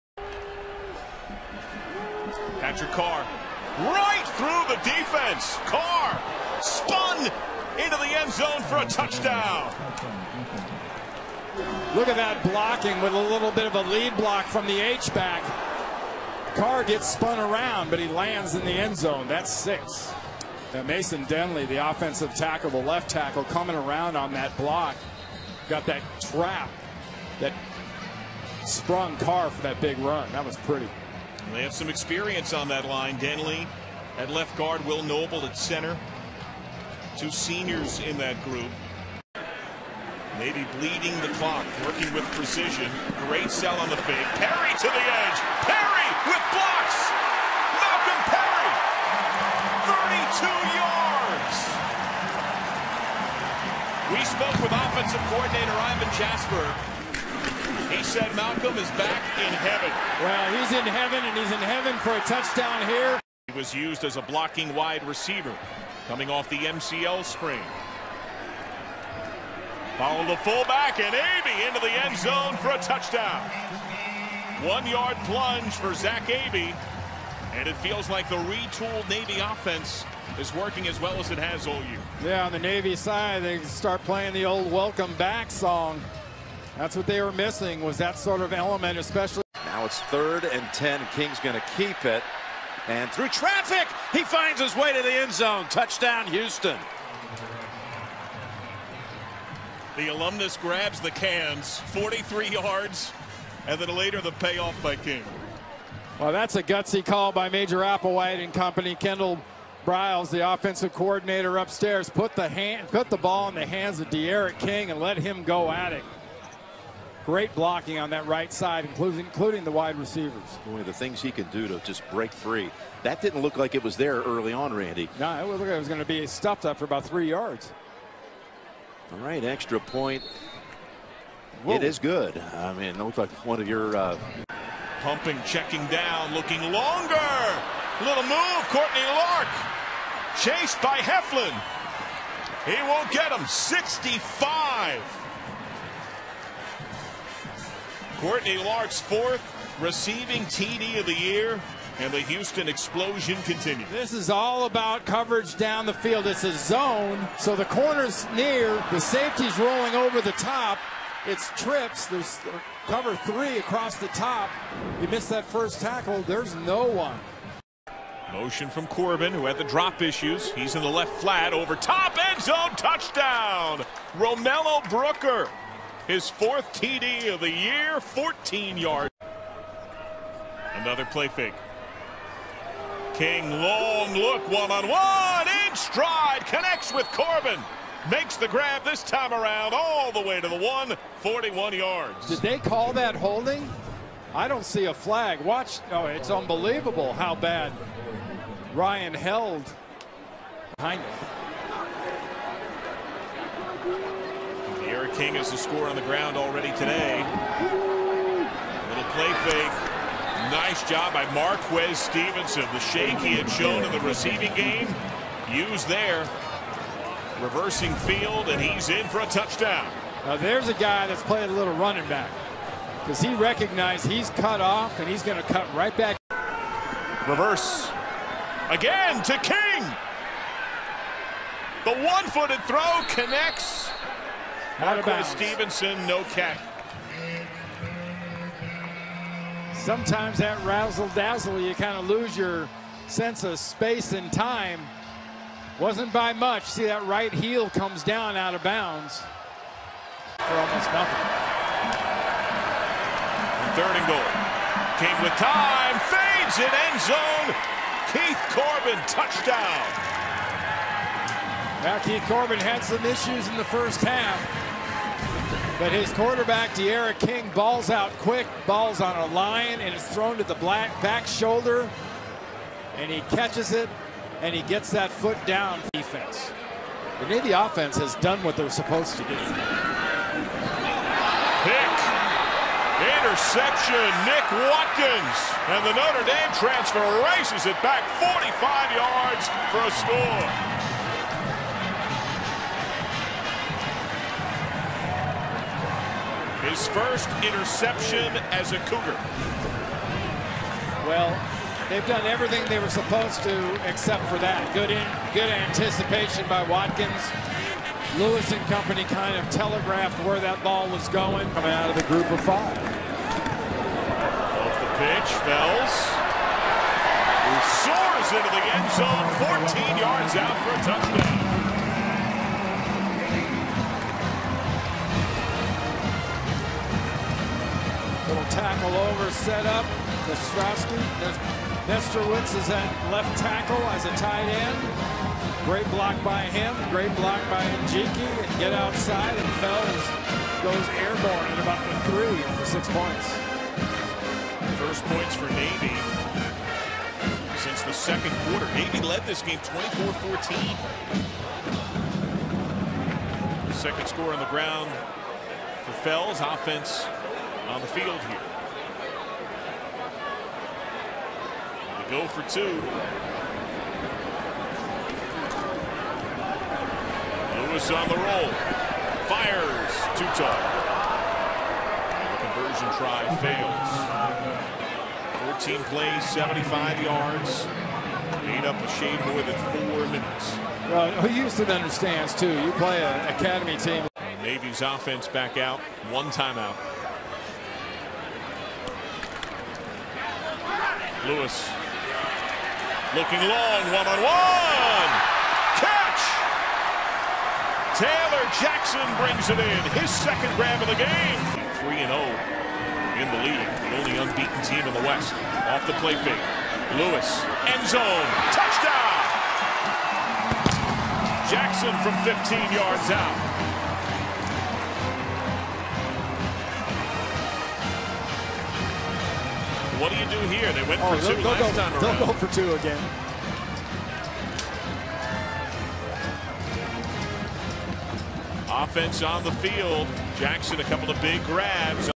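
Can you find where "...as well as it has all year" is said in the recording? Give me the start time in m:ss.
1:20.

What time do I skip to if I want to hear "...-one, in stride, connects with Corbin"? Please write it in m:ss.
3:05.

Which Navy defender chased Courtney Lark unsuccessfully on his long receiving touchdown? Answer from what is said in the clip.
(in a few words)
Heflin.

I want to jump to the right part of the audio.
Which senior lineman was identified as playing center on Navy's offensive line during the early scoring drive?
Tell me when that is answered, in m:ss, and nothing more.
0:34.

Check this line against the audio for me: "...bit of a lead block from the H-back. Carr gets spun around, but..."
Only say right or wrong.
right.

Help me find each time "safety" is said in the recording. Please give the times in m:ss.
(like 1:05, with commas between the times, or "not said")
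2:39.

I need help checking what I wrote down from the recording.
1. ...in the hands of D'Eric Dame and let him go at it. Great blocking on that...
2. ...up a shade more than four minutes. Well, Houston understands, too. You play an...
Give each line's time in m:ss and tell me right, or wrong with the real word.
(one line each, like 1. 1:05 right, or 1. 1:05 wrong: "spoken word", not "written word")
1. 1:53 wrong: "King", not "Dame"
2. 6:18 right.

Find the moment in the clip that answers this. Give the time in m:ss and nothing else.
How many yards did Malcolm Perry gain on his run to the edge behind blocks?
0:50.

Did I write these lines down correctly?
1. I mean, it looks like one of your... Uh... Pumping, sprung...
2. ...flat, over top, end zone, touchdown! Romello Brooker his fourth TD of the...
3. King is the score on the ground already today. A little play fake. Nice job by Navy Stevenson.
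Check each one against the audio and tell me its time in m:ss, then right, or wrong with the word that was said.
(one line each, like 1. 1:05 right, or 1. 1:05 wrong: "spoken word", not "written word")
1. 2:12 wrong: "checking", not "sprung"
2. 2:51 right
3. 3:25 wrong: "Marquez", not "Navy".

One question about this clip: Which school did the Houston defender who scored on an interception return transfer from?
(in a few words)
Notre Dame.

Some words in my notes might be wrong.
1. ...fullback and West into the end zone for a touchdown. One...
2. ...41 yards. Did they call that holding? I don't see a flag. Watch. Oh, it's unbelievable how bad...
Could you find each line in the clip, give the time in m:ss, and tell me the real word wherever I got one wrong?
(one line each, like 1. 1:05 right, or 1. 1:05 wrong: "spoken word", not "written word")
1. 1:10 wrong: "Abey", not "West"
2. 3:11 right.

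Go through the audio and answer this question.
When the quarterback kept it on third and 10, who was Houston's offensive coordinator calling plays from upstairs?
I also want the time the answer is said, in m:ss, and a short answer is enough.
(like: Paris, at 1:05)
Kendal Briles, at 1:48.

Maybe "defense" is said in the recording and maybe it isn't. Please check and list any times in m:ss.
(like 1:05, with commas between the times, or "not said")
0:04, 4:35.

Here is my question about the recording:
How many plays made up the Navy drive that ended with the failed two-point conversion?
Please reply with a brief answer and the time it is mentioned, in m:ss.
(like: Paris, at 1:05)
14, at 6:15.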